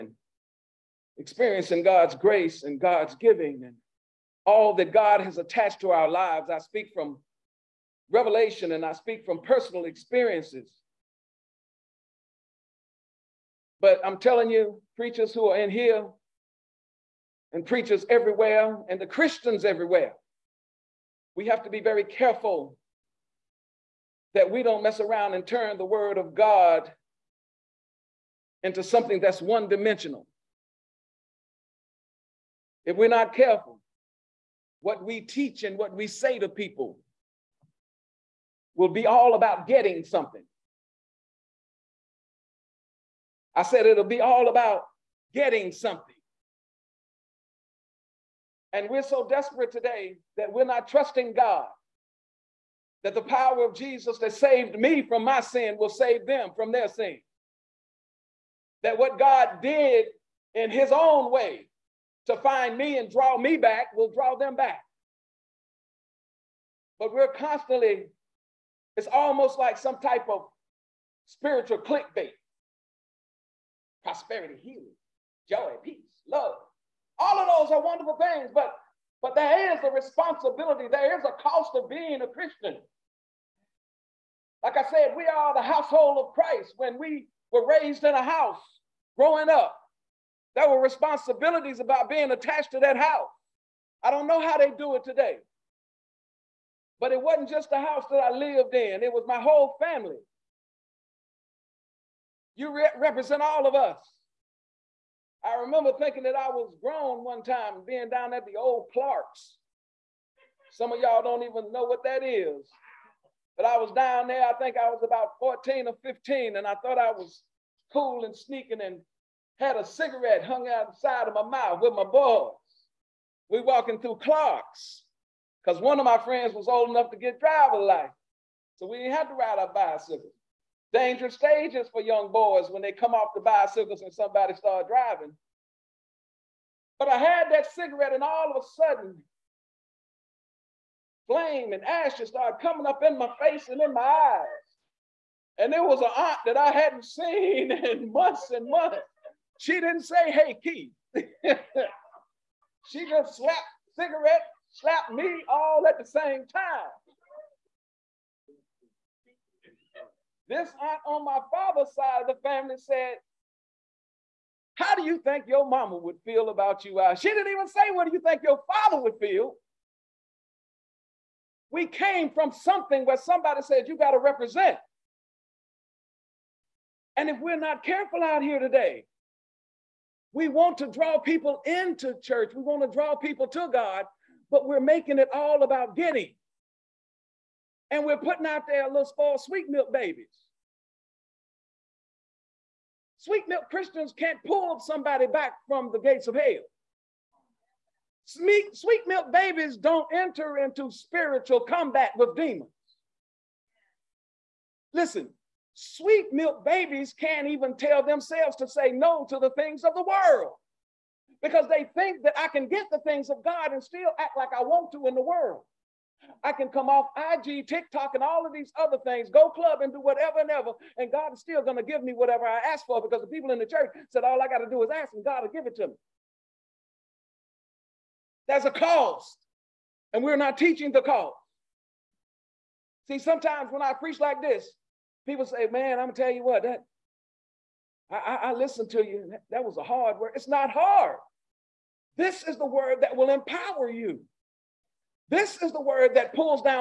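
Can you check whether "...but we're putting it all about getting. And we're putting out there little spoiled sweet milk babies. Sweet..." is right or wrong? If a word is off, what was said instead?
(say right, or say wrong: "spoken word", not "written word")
wrong: "making", not "putting".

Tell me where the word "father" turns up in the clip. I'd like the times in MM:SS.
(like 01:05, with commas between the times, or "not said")
02:41, 02:48.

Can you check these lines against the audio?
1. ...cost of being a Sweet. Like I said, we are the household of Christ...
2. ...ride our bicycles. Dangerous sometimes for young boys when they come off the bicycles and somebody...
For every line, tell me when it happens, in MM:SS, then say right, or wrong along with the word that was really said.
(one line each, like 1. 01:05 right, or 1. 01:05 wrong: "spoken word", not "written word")
1. 01:21 wrong: "Christian", not "Sweet"
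2. 02:09 wrong: "stages", not "sometimes".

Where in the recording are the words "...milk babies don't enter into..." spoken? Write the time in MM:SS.
03:19.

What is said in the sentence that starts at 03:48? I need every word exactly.
There's a cost, and we're not teaching the cost.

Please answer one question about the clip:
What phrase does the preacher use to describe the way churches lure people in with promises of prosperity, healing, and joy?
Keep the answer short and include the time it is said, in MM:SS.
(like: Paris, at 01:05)
spiritual clickbait, at 01:11.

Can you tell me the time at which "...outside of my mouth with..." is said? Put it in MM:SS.
02:00.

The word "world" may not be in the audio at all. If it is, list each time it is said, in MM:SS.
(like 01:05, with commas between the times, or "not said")
03:30, 03:35.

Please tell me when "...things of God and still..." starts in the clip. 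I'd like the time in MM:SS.
03:32.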